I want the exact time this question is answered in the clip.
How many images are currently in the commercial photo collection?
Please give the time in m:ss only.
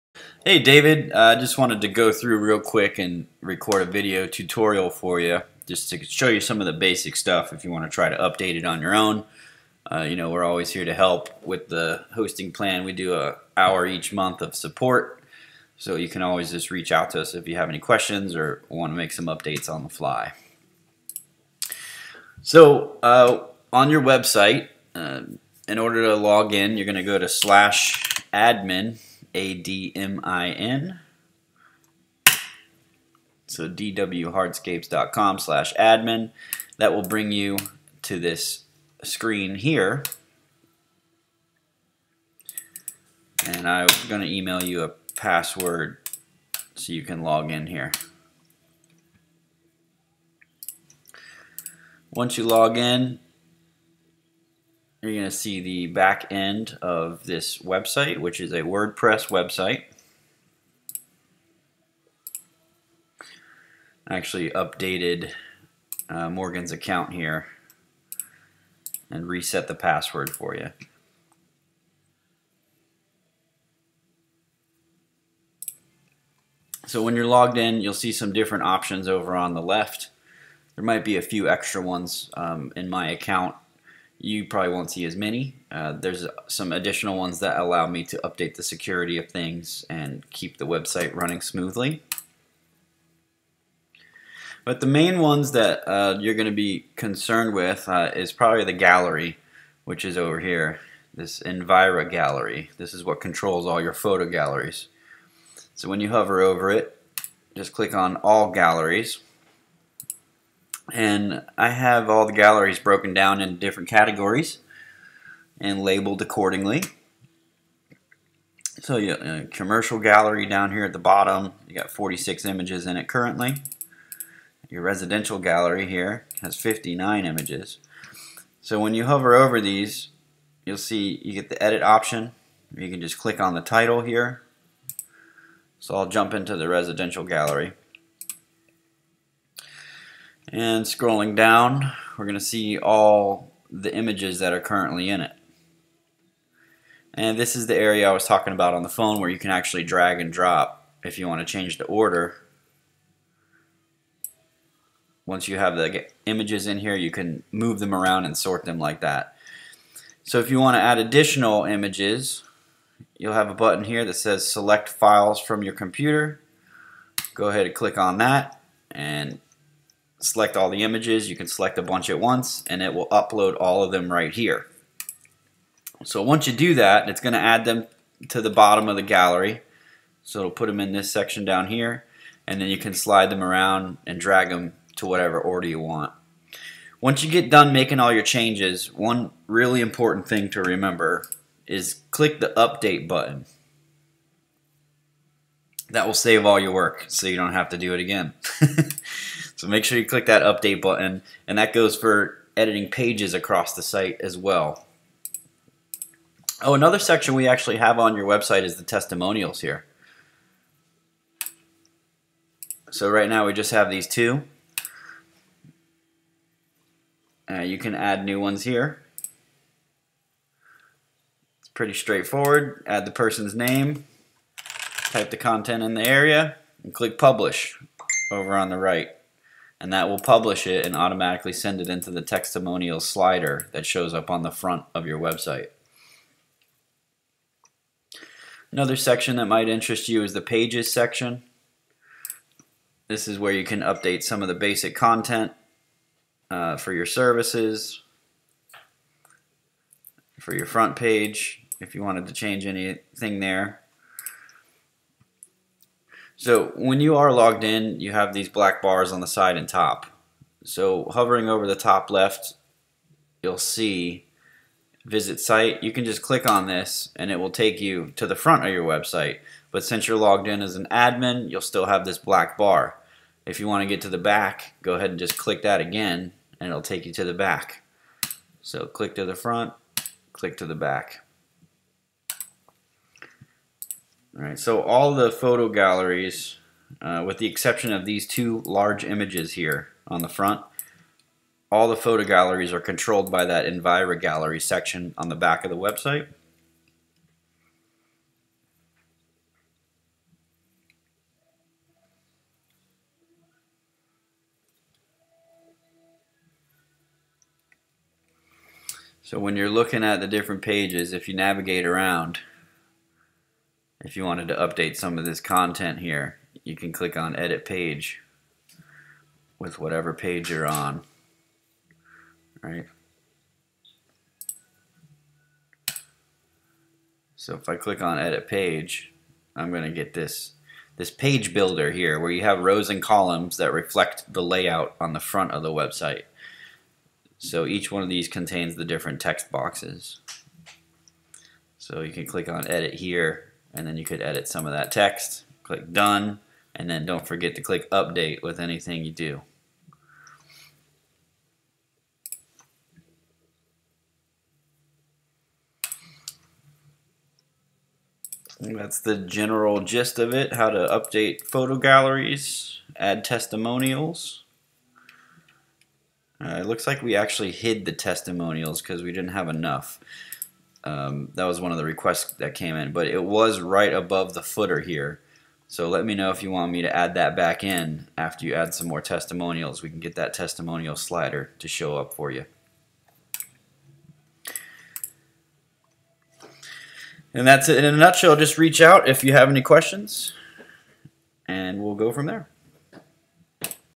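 2:01.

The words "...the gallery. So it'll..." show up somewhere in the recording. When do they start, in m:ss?
2:58.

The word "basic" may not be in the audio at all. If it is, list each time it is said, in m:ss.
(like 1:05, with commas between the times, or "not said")
0:06, 4:04.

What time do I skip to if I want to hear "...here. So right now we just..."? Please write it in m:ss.
3:29.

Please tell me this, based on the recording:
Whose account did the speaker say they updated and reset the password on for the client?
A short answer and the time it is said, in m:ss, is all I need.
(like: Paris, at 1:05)
Morgan, at 1:06.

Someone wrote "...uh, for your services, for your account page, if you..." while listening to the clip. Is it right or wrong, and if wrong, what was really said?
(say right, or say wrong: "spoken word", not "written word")
wrong: "front", not "account".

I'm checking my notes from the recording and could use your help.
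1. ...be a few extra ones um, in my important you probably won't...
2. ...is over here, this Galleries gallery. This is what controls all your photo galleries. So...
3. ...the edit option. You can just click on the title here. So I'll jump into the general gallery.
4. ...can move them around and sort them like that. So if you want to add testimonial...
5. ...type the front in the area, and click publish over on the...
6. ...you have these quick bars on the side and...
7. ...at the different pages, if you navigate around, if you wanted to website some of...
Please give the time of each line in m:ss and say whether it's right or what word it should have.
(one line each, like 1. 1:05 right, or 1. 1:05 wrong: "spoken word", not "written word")
1. 1:21 wrong: "account", not "important"
2. 1:40 wrong: "Envira", not "Galleries"
3. 2:11 wrong: "residential", not "general"
4. 2:37 wrong: "additional", not "testimonial"
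5. 3:45 wrong: "content", not "front"
6. 4:17 wrong: "black", not "quick"
7. 5:10 wrong: "update", not "website".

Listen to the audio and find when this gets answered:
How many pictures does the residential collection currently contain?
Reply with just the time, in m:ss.
2:06.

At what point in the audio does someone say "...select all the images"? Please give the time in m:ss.
2:50.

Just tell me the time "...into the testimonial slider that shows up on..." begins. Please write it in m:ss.
3:51.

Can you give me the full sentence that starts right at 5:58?
That's the general gist of it, how to update photo galleries, add testimonials.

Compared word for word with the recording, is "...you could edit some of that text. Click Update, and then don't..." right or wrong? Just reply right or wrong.
wrong.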